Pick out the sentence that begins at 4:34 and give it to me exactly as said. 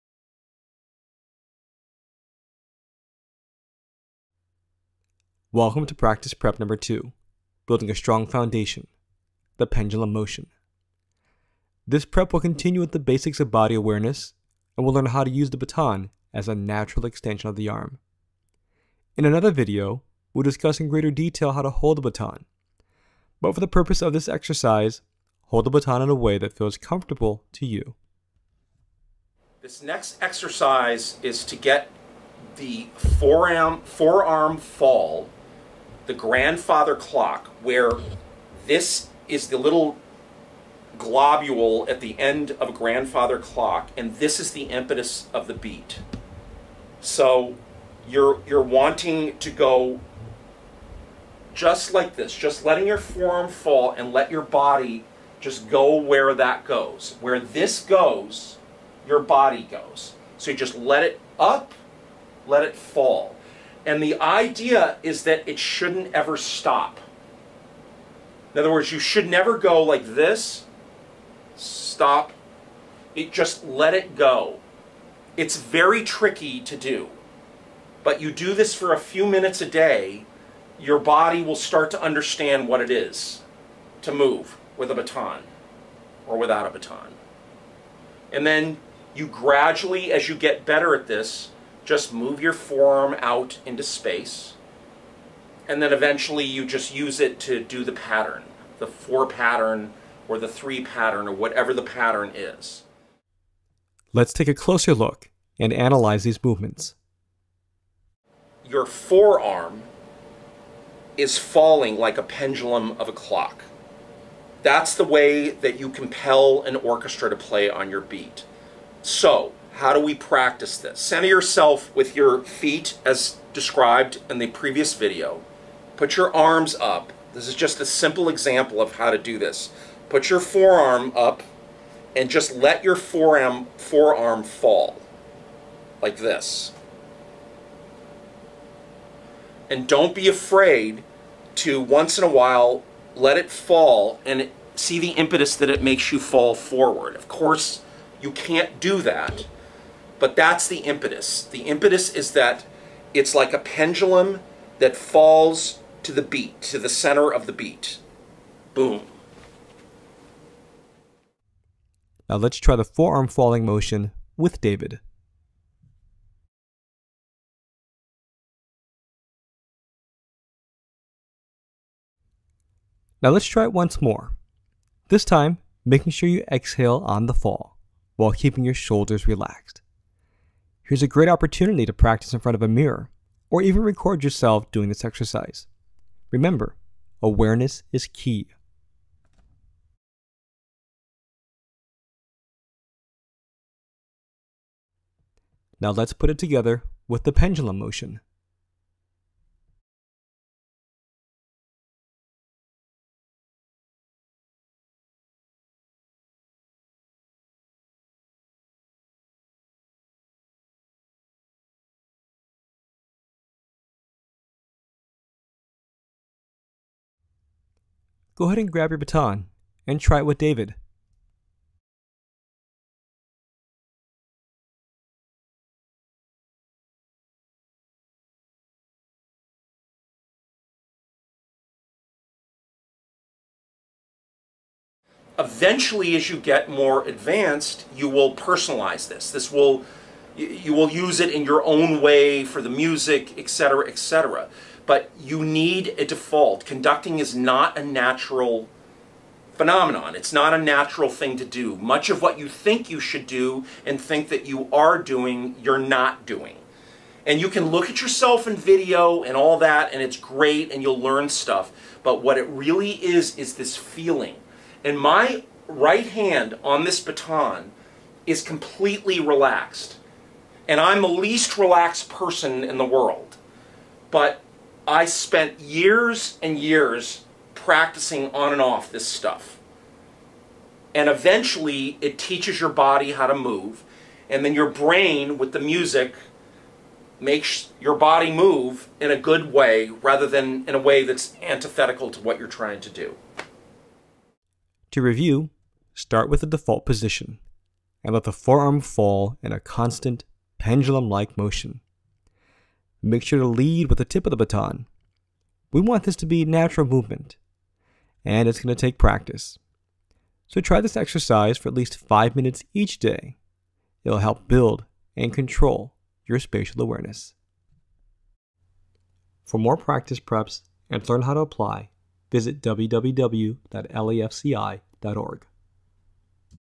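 But I spent years and years practicing on and off this stuff.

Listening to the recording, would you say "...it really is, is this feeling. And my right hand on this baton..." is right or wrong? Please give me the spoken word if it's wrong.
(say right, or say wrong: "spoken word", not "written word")
right.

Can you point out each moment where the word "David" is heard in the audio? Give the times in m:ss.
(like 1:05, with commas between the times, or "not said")
2:44, 3:40.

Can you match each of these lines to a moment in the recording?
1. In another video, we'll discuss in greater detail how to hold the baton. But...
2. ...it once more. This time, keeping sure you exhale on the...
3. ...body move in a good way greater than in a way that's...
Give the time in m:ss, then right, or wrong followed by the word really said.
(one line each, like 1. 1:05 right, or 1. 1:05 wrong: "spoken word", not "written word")
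1. 0:19 right
2. 2:53 wrong: "making", not "keeping"
3. 4:47 wrong: "rather", not "greater".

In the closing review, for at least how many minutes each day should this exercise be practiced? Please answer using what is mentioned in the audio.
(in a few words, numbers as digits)
5.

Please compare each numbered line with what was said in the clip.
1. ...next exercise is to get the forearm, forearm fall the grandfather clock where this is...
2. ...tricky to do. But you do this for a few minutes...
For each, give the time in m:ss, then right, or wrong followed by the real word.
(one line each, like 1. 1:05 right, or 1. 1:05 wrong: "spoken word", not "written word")
1. 0:29 right
2. 1:16 right.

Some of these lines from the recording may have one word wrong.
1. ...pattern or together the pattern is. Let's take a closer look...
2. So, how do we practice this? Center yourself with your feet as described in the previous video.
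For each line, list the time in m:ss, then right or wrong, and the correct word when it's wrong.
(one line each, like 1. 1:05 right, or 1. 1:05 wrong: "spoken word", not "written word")
1. 1:40 wrong: "whatever", not "together"
2. 1:59 right.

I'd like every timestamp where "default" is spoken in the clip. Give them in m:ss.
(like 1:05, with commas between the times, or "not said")
4:06, 4:56.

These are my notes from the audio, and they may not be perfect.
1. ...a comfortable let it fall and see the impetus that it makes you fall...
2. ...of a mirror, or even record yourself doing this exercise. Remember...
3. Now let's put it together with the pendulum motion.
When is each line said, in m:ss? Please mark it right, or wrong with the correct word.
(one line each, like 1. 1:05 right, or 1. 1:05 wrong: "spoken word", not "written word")
1. 2:22 wrong: "while", not "comfortable"
2. 3:02 right
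3. 3:15 right.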